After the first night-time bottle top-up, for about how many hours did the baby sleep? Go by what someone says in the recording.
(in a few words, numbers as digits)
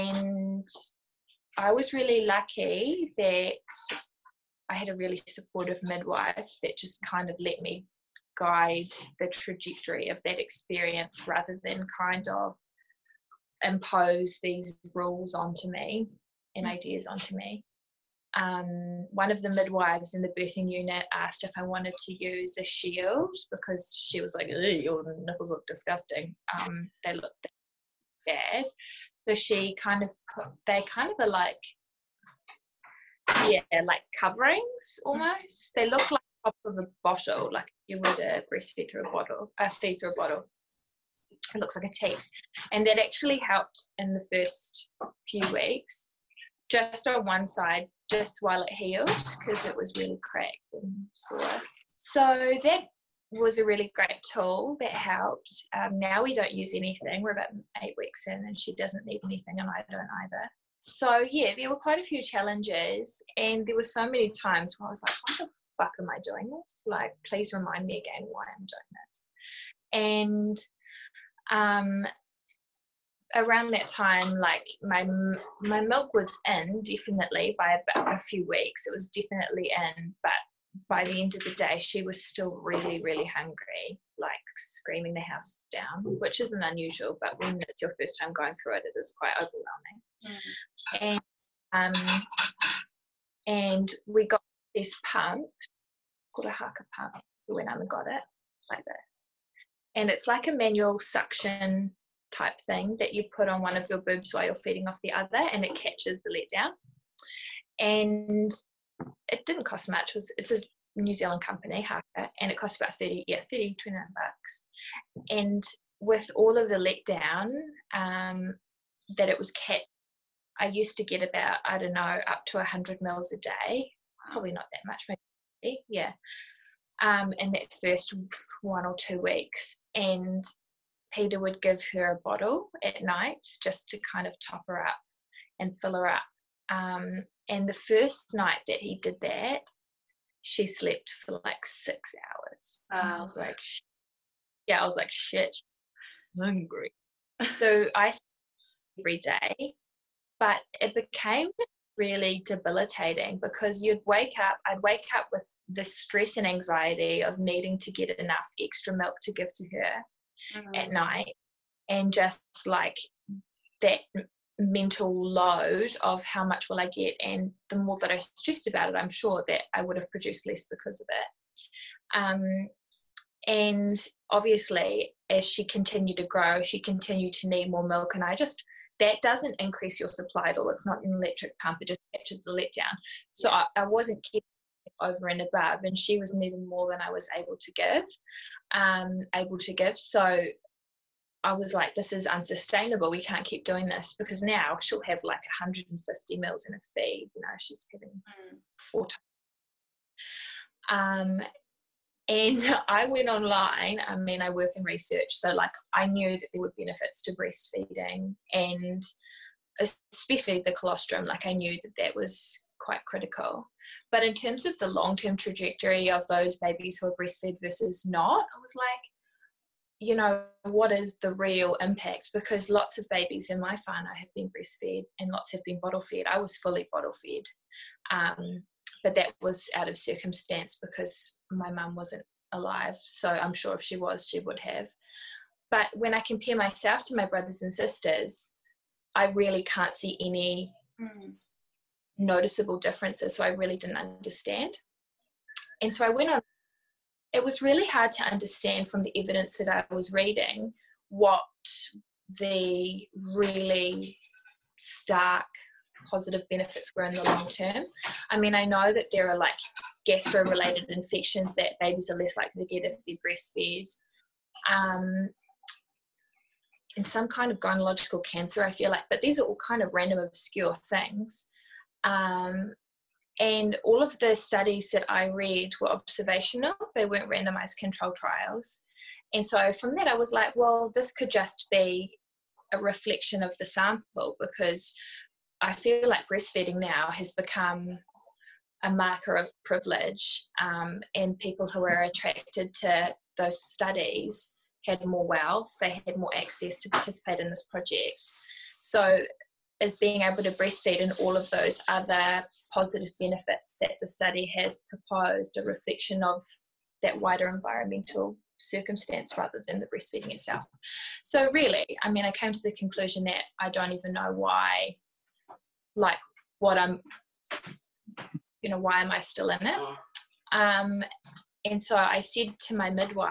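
6 hours.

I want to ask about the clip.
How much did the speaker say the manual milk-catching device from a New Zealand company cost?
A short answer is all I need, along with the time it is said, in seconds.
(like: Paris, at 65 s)
$29, at 113 s.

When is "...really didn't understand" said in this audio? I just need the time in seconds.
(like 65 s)
243 s.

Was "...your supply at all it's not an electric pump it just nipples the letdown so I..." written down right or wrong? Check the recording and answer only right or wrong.
wrong.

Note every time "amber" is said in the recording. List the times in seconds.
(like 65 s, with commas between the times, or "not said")
not said.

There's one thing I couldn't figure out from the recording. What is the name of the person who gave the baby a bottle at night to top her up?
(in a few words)
Peter.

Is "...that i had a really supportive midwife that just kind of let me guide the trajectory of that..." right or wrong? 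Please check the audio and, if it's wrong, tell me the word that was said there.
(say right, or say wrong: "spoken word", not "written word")
right.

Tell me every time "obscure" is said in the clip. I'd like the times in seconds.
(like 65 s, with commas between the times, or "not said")
270 s.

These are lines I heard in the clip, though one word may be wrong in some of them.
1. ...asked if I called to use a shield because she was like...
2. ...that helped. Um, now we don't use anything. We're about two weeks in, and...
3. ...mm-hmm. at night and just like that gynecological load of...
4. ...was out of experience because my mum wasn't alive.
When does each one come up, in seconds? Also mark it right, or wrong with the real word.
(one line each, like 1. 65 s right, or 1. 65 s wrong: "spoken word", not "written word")
1. 21 s wrong: "wanted", not "called"
2. 54 s wrong: "eight", not "two"
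3. 160 s wrong: "mental", not "gynecological"
4. 229 s wrong: "circumstance", not "experience".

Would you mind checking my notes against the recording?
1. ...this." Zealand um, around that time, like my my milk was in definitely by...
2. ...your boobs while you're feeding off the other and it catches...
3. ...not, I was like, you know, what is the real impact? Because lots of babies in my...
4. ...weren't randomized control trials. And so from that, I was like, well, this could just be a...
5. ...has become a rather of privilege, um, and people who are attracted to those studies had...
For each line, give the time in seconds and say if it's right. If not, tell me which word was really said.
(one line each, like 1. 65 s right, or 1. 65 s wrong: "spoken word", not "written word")
1. 70 s wrong: "And", not "Zealand"
2. 103 s right
3. 218 s right
4. 277 s right
5. 287 s wrong: "marker", not "rather".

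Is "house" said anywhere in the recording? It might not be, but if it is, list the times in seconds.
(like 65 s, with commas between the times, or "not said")
85 s.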